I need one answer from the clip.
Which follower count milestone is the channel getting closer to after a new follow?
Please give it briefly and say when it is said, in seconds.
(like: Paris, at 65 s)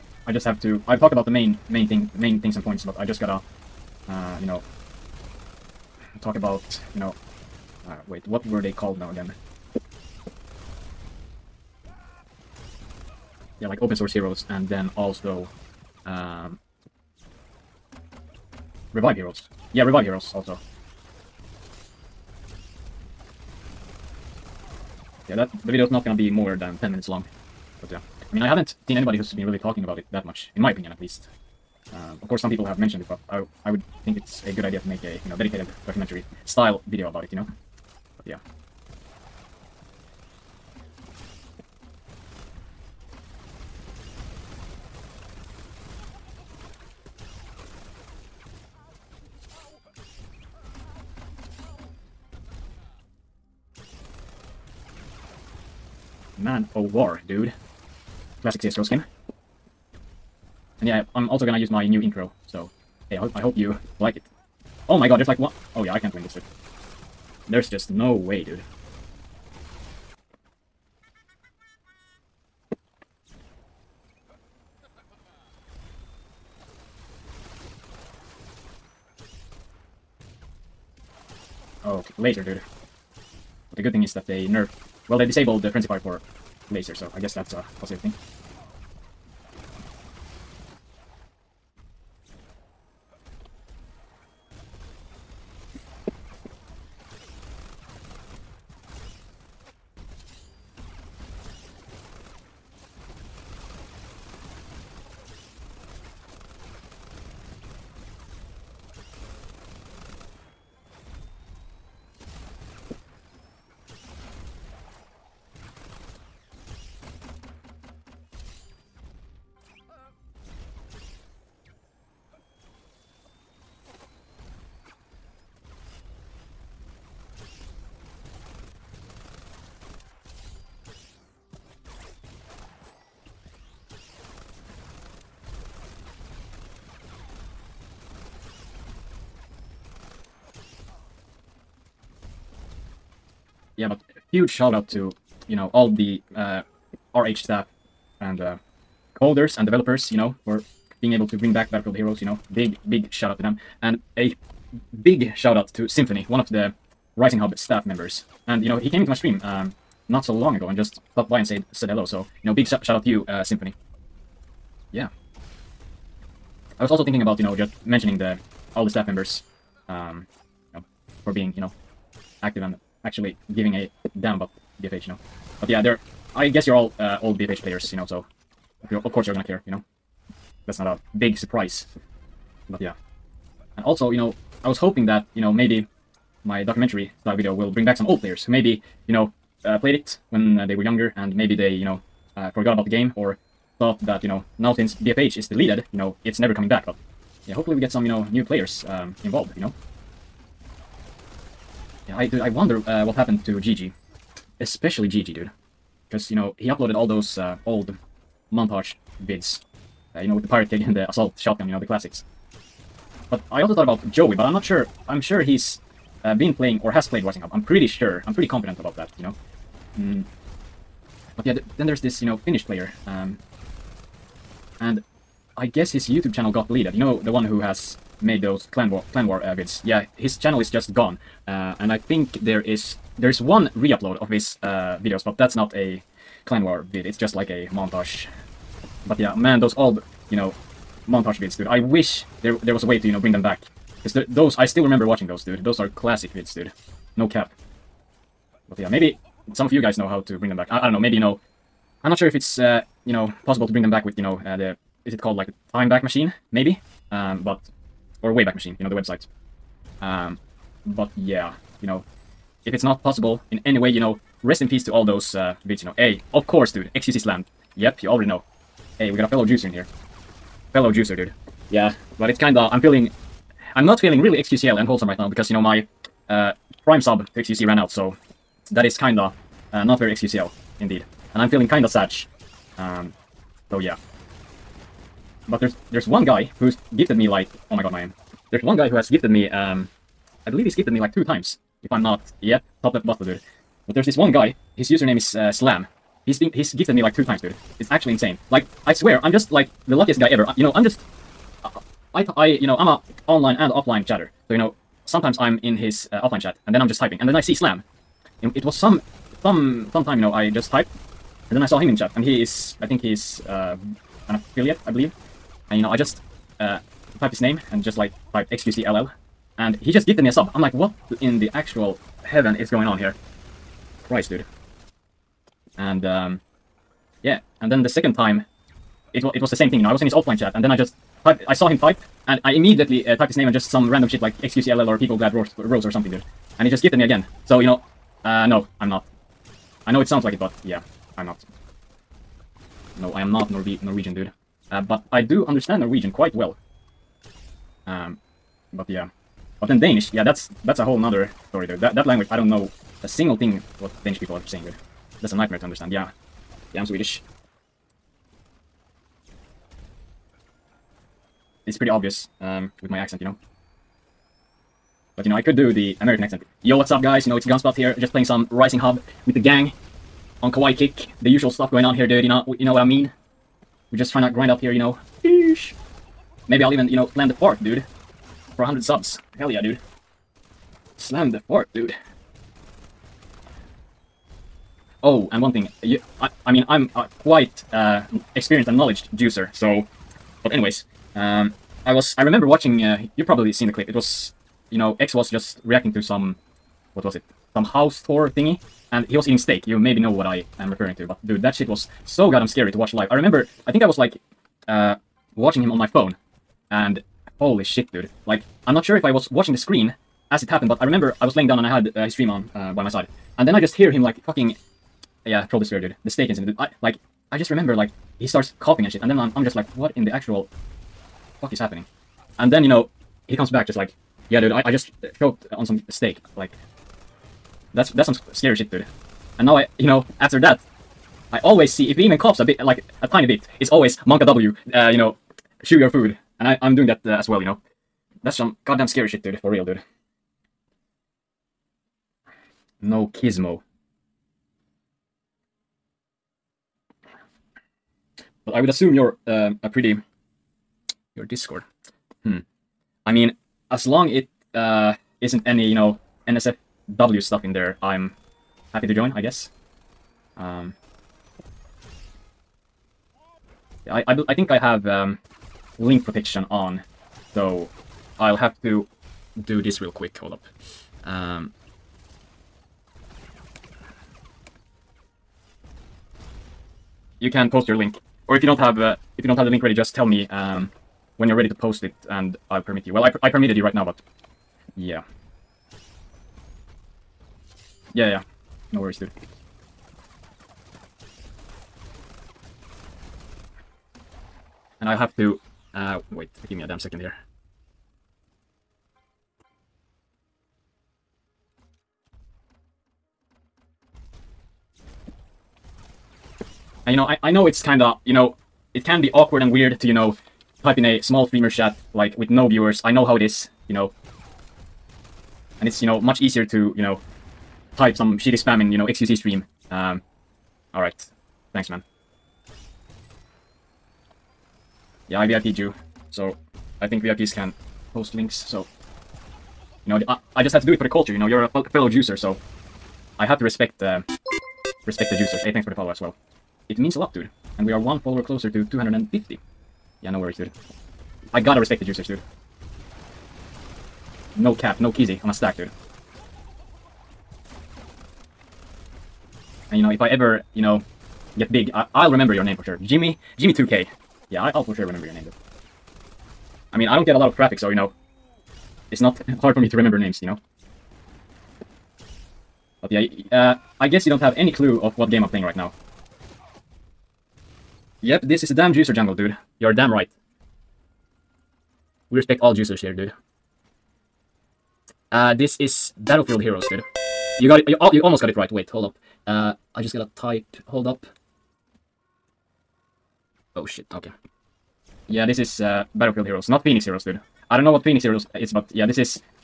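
250, at 538 s.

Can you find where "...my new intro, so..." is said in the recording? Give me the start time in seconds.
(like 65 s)
61 s.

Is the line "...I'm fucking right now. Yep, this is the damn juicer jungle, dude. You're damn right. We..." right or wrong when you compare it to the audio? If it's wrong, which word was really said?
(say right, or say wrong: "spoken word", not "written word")
wrong: "playing", not "fucking".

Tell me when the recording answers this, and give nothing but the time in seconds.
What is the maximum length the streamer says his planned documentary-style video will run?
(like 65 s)
26 s.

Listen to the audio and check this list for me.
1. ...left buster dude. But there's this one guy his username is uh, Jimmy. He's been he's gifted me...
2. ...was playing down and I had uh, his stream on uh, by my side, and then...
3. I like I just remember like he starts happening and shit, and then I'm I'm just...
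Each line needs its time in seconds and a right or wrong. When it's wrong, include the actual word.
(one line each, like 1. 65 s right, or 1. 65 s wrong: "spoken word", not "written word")
1. 292 s wrong: "Slam", not "Jimmy"
2. 411 s wrong: "laying", not "playing"
3. 416 s wrong: "coughing", not "happening".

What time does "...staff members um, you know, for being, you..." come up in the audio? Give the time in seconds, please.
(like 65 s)
168 s.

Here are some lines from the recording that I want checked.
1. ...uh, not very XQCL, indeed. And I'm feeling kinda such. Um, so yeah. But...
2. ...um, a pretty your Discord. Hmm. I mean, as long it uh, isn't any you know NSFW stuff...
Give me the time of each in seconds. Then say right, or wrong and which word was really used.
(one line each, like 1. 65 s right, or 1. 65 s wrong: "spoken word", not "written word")
1. 279 s right
2. 449 s right.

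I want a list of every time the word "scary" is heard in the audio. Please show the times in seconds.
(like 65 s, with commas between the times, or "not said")
402 s, 428 s, 438 s.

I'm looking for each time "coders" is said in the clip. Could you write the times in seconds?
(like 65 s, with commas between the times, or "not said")
149 s.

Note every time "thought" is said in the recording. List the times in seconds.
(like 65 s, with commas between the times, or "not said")
193 s, 213 s.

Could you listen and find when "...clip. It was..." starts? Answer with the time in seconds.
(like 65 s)
393 s.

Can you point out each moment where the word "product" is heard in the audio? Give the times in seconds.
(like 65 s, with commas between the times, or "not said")
not said.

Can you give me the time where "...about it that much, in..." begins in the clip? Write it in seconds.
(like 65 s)
29 s.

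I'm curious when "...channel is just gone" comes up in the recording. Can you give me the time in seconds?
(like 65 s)
230 s.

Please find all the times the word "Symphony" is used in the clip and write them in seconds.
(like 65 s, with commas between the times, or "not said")
155 s, 163 s.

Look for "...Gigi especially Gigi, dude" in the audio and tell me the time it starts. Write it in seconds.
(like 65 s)
203 s.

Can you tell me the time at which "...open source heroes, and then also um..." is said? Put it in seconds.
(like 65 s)
13 s.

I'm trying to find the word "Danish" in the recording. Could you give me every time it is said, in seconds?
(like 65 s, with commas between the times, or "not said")
349 s, 354 s.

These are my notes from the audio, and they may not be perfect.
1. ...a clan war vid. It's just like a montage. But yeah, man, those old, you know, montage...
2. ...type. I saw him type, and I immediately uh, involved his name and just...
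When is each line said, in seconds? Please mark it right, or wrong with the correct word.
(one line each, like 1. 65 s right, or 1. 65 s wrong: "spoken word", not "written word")
1. 235 s right
2. 331 s wrong: "typed", not "involved".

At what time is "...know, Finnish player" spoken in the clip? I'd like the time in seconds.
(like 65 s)
222 s.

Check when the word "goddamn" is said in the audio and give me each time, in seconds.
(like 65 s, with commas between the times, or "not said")
402 s, 438 s.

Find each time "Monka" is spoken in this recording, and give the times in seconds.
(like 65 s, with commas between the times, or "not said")
434 s.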